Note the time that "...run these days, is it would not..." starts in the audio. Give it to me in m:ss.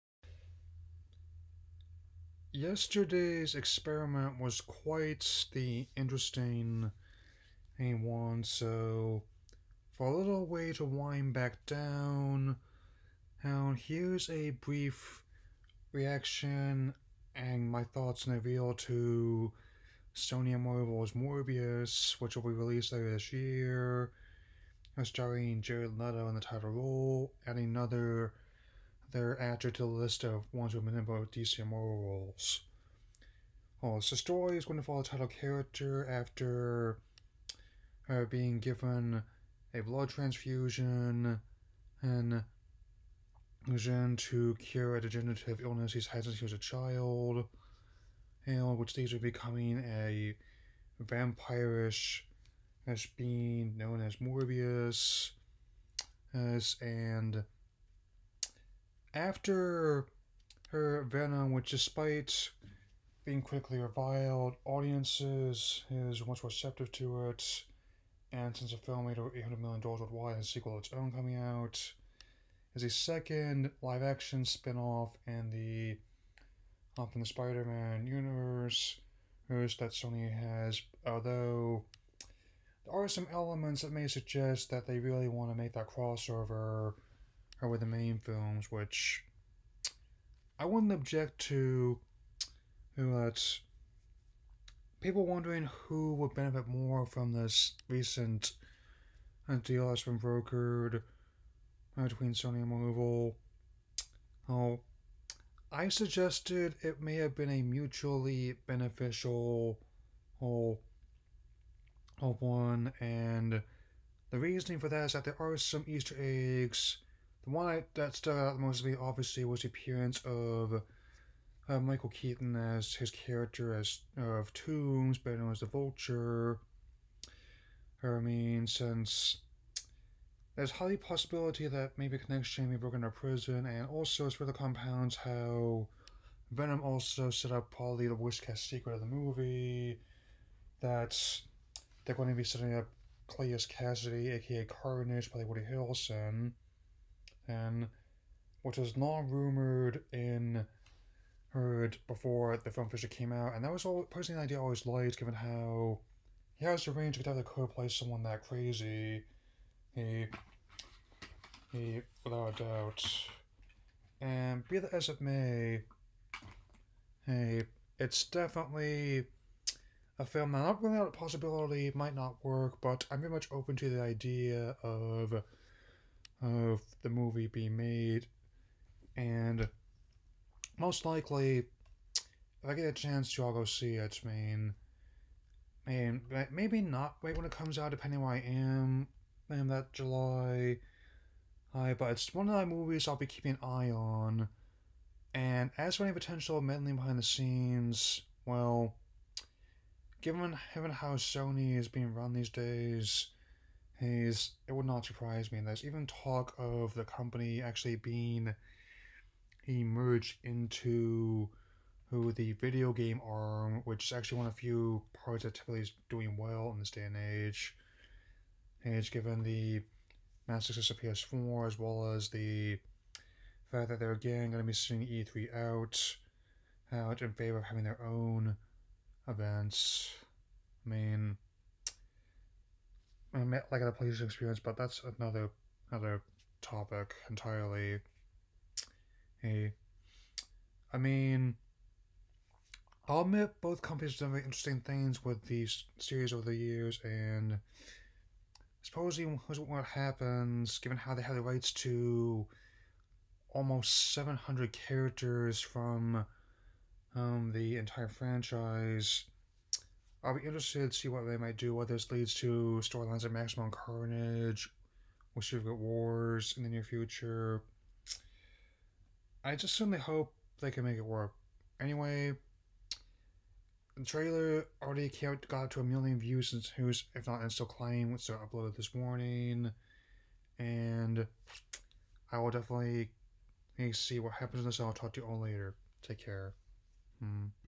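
3:22.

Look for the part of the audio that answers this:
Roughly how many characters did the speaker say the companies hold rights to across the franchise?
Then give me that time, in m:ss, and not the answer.
4:14.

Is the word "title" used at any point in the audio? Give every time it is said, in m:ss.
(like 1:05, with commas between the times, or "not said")
0:26, 0:35.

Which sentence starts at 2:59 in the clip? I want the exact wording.
And most likely, if I get a chance to, I'll go see it.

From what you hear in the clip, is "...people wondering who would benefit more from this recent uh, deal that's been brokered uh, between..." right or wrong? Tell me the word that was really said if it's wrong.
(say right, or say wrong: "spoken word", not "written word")
right.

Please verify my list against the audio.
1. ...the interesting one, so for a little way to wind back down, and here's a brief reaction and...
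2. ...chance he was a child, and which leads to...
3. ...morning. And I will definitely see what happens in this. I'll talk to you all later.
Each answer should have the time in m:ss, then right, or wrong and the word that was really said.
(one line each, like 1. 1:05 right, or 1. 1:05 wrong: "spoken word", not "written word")
1. 0:05 right
2. 0:46 wrong: "since", not "chance"
3. 4:38 right.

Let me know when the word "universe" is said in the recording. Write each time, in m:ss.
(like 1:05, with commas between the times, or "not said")
1:18.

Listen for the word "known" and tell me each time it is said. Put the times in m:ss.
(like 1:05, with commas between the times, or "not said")
0:53, 2:05.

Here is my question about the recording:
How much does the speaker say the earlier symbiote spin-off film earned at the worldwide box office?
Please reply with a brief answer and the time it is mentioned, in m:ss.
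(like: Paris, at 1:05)
Over $800 million, at 1:09.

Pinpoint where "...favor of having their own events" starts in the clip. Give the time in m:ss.
3:47.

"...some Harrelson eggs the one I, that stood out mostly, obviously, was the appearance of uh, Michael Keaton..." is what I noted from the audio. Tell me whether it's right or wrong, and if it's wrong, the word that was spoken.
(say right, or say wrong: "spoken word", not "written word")
wrong: "Easter", not "Harrelson".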